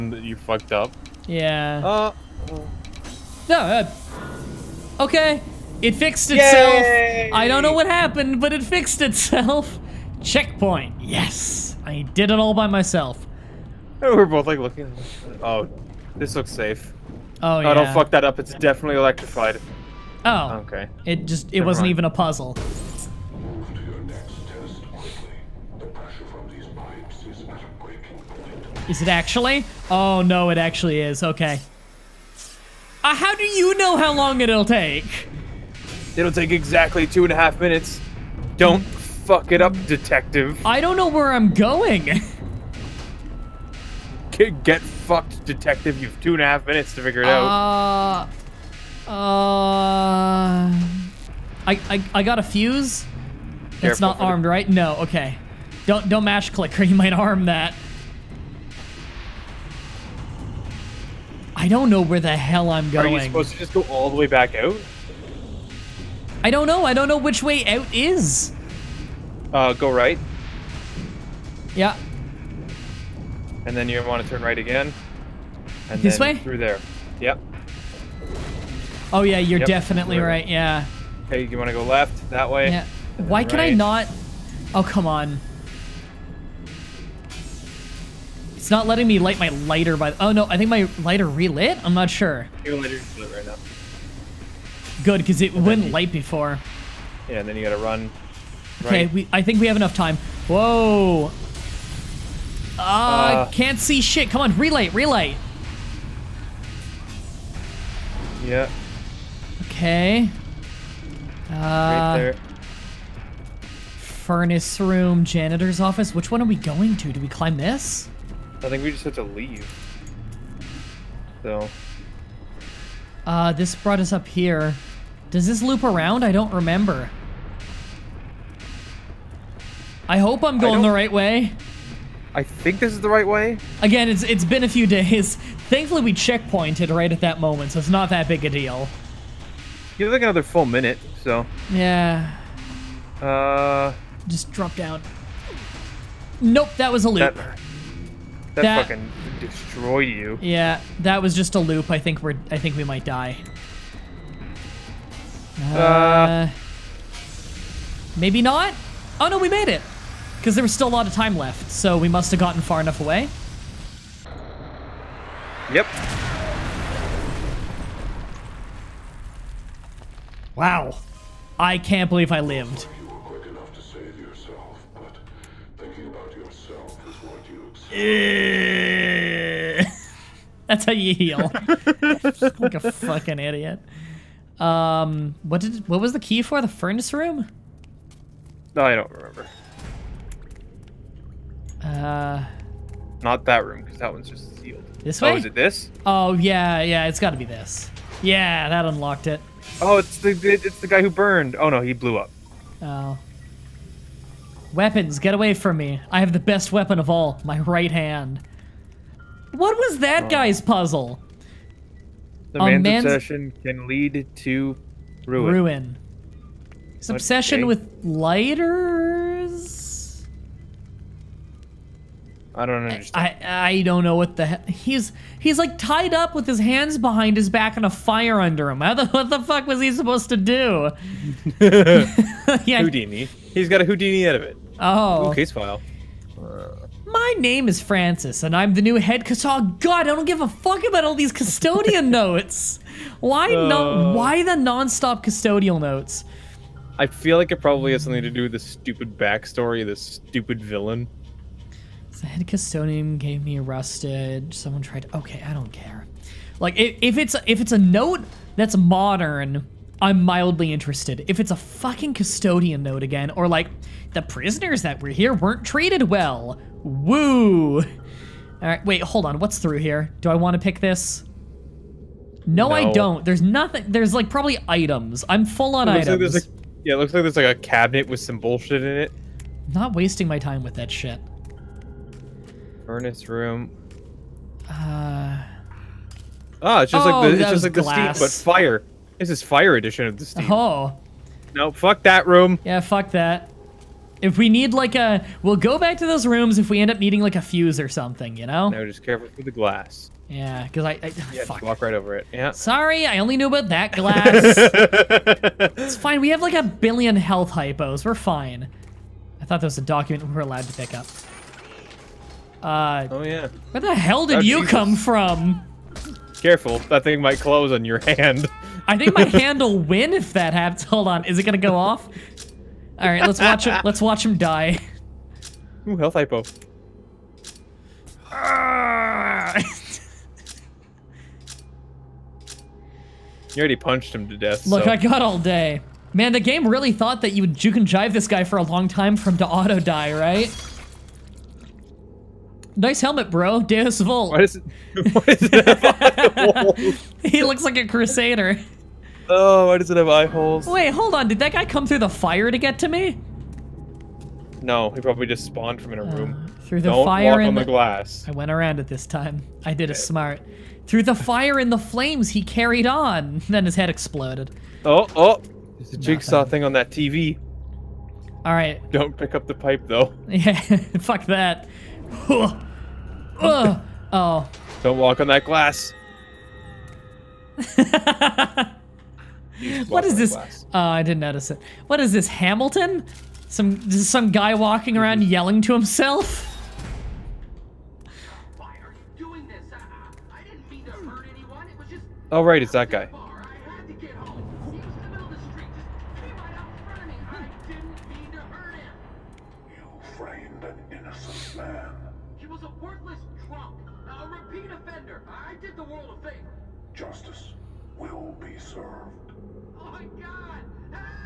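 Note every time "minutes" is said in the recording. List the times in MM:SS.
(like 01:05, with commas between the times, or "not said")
00:37, 00:46, 02:20.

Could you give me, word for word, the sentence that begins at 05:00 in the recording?
Yeah, because I, I yeah, fuck.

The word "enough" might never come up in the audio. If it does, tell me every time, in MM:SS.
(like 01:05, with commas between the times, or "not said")
01:39, 02:42.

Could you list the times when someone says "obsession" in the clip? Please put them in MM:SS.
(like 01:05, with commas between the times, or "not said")
03:33, 03:37.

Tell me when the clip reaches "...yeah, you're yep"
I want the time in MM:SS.
01:19.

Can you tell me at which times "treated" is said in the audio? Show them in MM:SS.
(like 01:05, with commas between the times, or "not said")
04:25.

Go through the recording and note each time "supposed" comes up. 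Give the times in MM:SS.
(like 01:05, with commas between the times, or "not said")
01:03, 03:49.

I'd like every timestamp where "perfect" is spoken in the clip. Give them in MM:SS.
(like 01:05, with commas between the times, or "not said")
not said.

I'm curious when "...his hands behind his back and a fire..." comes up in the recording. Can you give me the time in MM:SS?
03:46.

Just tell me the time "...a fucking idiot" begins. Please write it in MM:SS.
03:02.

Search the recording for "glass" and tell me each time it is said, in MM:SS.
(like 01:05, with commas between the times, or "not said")
04:47, 04:59, 05:03, 05:57, 06:15.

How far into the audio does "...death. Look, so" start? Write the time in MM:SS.
05:34.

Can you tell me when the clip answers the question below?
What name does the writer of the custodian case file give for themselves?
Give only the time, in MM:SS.
03:57.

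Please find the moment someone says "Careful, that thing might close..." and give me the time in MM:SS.
05:16.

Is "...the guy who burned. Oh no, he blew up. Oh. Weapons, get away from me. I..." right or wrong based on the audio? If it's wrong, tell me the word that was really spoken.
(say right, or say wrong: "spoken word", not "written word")
right.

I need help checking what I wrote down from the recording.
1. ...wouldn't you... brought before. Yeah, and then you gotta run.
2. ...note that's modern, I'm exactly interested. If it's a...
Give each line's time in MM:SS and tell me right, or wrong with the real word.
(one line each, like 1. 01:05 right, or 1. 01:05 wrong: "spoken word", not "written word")
1. 01:35 wrong: "light", not "brought"
2. 04:17 wrong: "mildly", not "exactly".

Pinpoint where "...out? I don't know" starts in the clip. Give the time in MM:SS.
01:04.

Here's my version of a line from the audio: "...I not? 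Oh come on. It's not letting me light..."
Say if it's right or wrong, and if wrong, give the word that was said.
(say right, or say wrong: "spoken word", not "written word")
right.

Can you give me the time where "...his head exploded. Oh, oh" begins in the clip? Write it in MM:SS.
06:03.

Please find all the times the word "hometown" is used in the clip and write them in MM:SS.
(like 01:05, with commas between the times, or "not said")
not said.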